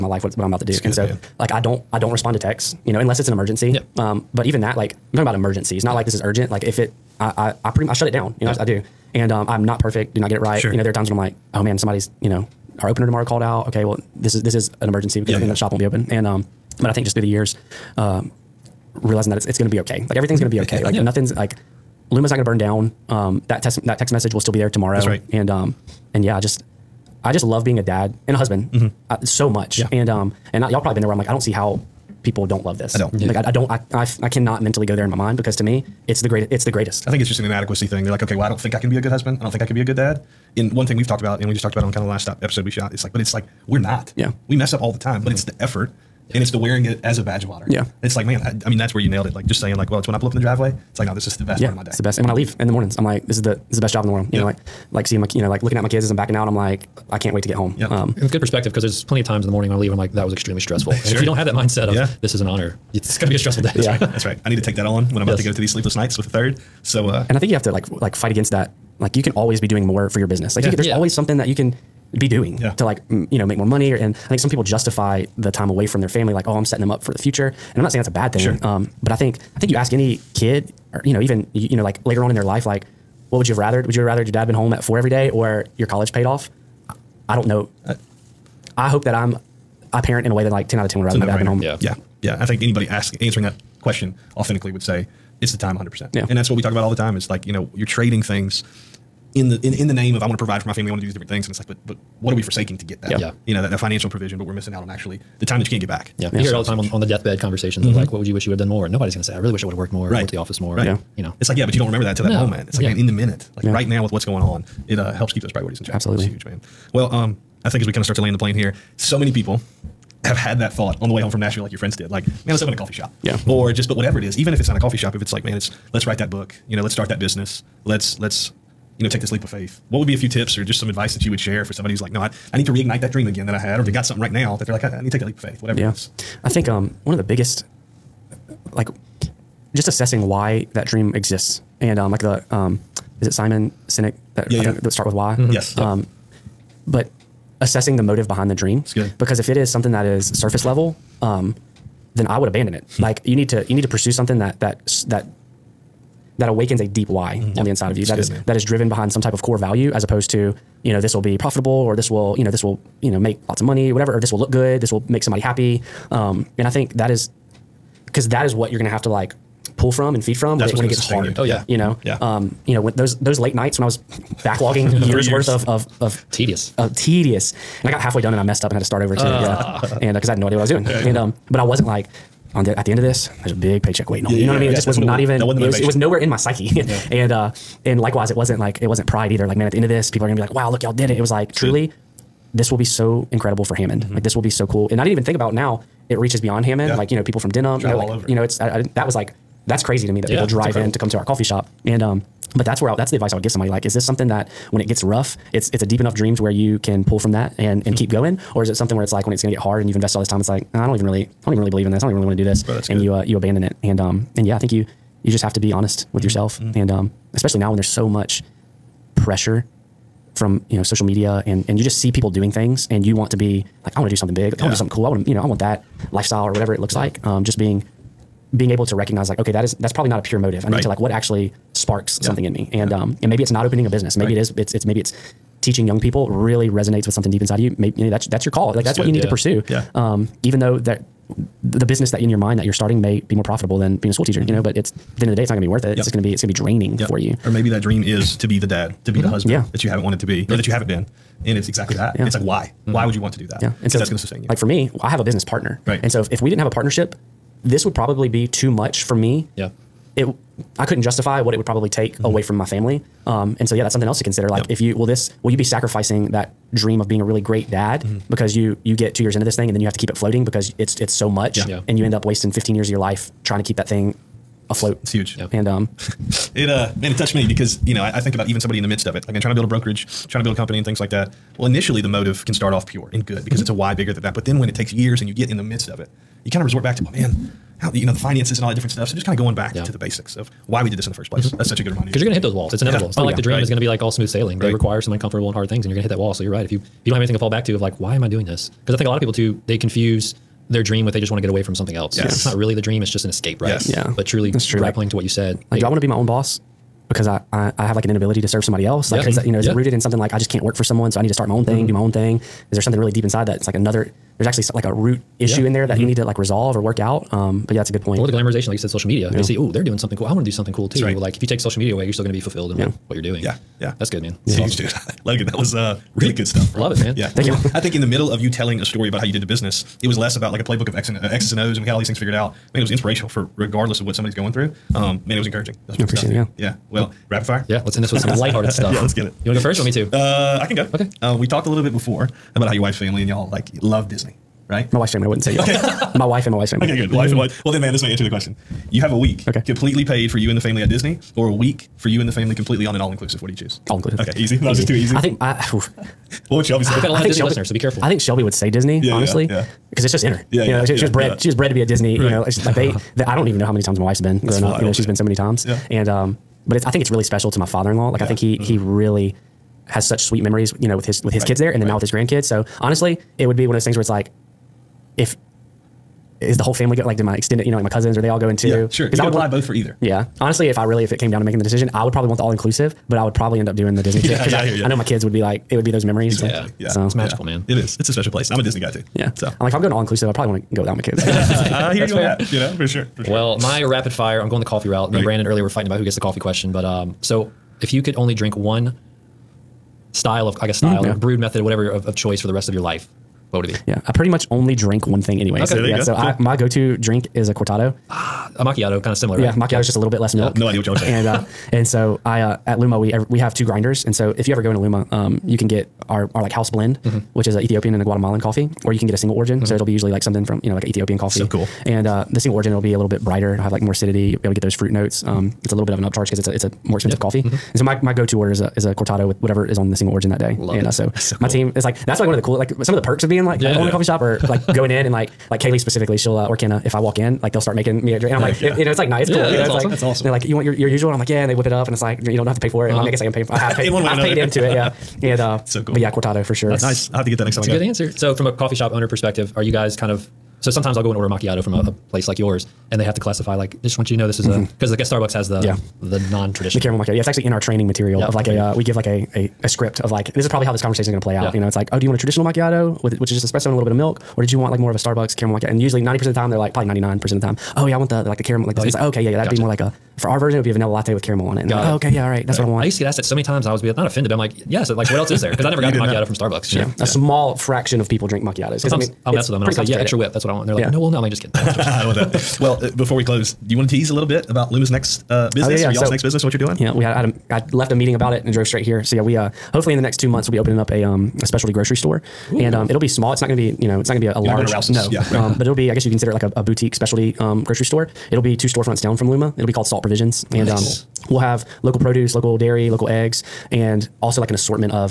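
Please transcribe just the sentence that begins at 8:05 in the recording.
or y'all's so, next business and what you're doing?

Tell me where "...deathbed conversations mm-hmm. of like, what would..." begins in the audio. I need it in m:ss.
1:47.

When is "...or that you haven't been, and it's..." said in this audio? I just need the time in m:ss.
4:10.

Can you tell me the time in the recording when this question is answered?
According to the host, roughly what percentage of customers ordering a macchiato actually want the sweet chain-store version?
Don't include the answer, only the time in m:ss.
7:46.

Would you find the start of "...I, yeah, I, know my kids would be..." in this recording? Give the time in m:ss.
6:24.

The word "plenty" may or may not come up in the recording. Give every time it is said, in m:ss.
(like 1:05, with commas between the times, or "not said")
0:59.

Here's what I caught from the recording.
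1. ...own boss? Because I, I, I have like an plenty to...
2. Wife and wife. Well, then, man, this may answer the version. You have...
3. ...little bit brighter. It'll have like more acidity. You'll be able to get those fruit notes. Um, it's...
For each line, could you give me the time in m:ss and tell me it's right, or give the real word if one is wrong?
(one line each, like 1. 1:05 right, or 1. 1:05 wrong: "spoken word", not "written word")
1. 5:06 wrong: "inability", not "plenty"
2. 5:47 wrong: "question", not "version"
3. 7:03 right.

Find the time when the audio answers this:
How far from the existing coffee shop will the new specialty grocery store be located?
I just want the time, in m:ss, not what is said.
8:18.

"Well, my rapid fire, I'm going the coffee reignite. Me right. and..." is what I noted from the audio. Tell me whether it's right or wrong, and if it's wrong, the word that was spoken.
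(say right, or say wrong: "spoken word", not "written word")
wrong: "route", not "reignite".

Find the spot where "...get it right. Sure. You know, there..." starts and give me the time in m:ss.
0:10.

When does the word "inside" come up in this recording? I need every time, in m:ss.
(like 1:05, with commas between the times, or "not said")
2:37, 3:57, 5:13.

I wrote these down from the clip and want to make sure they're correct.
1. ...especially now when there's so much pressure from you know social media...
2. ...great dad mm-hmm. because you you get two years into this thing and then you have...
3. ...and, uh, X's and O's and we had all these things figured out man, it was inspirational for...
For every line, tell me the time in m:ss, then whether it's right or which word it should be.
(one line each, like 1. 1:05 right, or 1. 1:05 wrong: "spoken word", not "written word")
1. 3:37 right
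2. 4:27 right
3. 5:31 right.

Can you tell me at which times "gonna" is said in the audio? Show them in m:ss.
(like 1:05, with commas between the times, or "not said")
2:48, 3:10.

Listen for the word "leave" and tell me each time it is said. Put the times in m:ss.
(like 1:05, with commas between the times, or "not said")
0:52, 0:59.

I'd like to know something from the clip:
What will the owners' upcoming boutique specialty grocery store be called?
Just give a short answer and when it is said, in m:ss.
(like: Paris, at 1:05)
Salt Provisions, at 8:19.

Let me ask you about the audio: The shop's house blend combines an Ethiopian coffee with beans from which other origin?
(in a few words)
Guatemalan.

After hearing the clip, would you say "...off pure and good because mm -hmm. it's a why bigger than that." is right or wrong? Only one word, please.
right.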